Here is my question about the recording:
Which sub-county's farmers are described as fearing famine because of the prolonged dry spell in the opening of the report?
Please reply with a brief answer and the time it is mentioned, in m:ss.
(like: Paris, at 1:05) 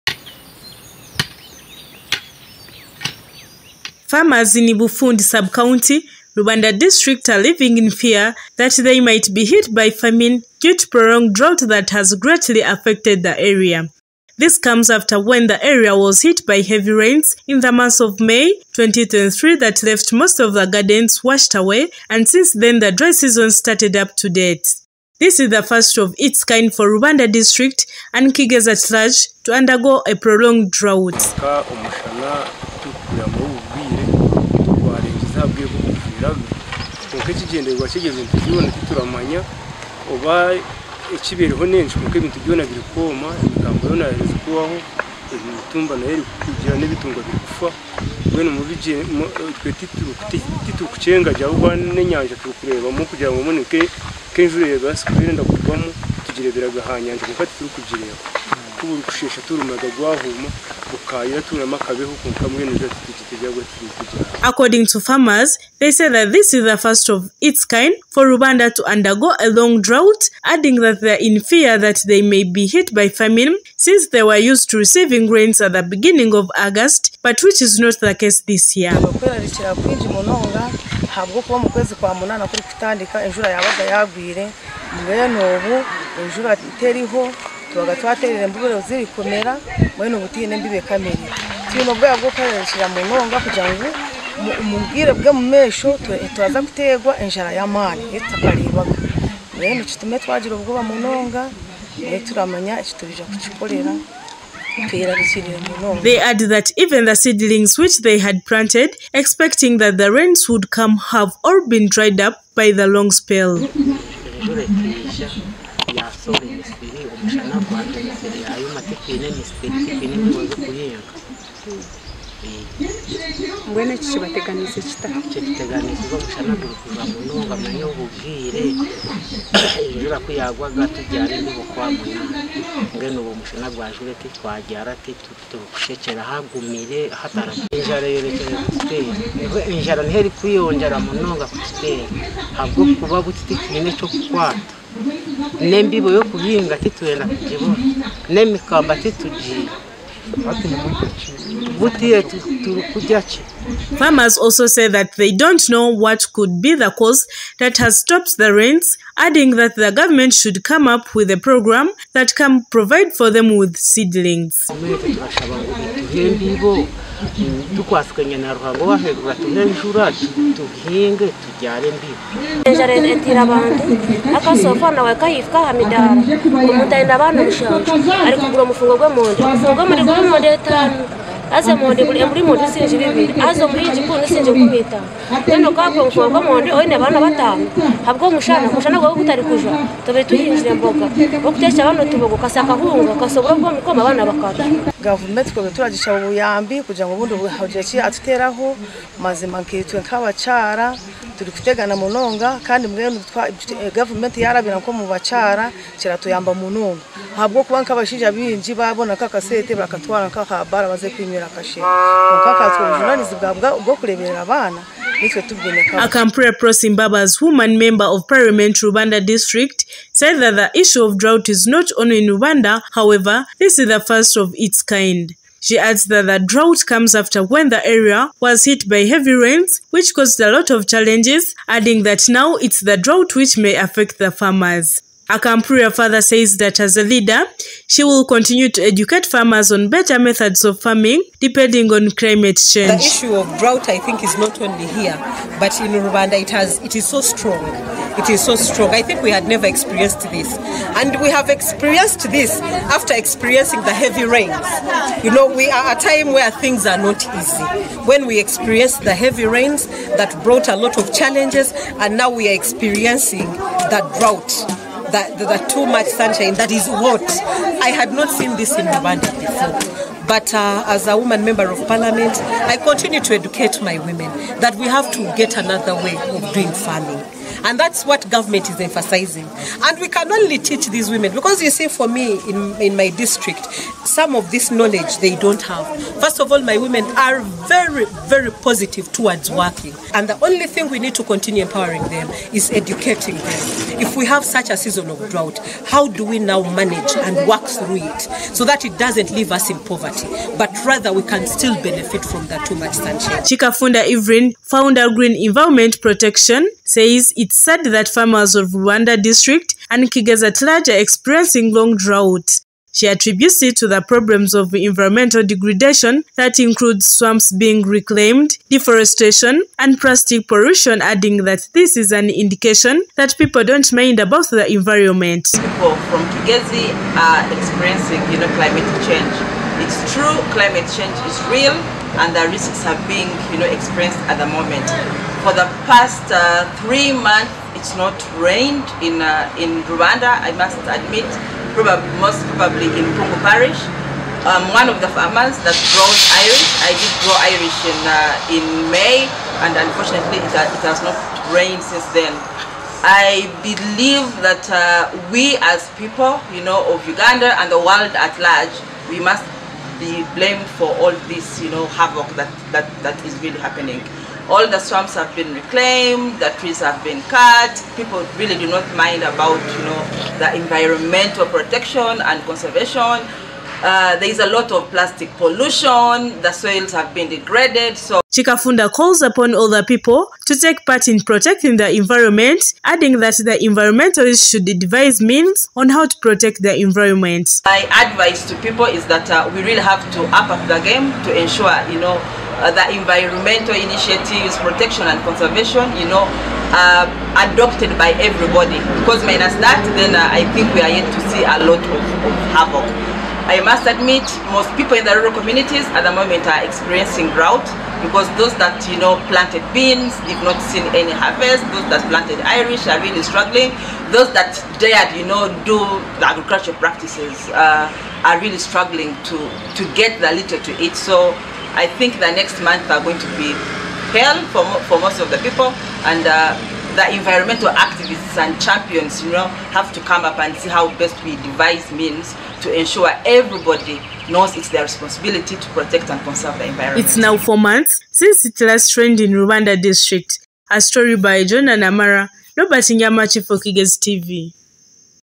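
Ibufundi, at 0:04.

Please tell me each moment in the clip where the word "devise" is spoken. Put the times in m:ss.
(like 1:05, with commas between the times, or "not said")
6:24, 7:11.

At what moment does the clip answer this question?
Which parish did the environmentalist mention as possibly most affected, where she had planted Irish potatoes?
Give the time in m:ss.
5:43.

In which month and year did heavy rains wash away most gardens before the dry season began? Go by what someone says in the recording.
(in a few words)
May 2023.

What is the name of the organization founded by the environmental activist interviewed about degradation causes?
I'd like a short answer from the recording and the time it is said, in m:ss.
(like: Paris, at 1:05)
Green Environment Protection, at 5:05.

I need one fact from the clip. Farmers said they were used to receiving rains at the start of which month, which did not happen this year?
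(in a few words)
August.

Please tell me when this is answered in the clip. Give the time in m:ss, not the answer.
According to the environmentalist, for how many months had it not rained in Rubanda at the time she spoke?
5:36.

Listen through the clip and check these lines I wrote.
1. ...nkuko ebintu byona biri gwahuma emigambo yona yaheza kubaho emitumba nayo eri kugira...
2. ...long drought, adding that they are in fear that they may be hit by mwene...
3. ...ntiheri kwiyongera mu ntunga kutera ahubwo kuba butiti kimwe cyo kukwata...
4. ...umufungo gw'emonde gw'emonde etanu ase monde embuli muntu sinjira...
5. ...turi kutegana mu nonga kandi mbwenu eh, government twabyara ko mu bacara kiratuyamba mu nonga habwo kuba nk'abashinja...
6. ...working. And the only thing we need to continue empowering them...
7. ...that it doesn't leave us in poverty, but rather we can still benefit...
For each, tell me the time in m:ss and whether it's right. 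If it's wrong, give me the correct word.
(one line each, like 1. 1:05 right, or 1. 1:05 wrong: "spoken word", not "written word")
1. 0:42 wrong: "kwoma", not "gwahuma"
2. 1:09 wrong: "famine", not "mwene"
3. 2:20 wrong: "ntabwo", not "ahubwo"
4. 2:59 right
5. 3:21 wrong: "yarabira", not "twabyara"
6. 4:49 right
7. 4:58 right.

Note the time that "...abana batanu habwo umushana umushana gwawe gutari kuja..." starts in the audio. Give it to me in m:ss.
3:06.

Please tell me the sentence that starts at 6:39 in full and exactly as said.
Because minus that, then uh, I think we are yet to see a lot of, of havoc.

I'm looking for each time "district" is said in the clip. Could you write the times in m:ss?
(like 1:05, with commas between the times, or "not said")
0:06, 0:27, 3:39, 4:43, 5:09, 7:19.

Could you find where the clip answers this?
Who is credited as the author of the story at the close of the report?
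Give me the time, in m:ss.
7:21.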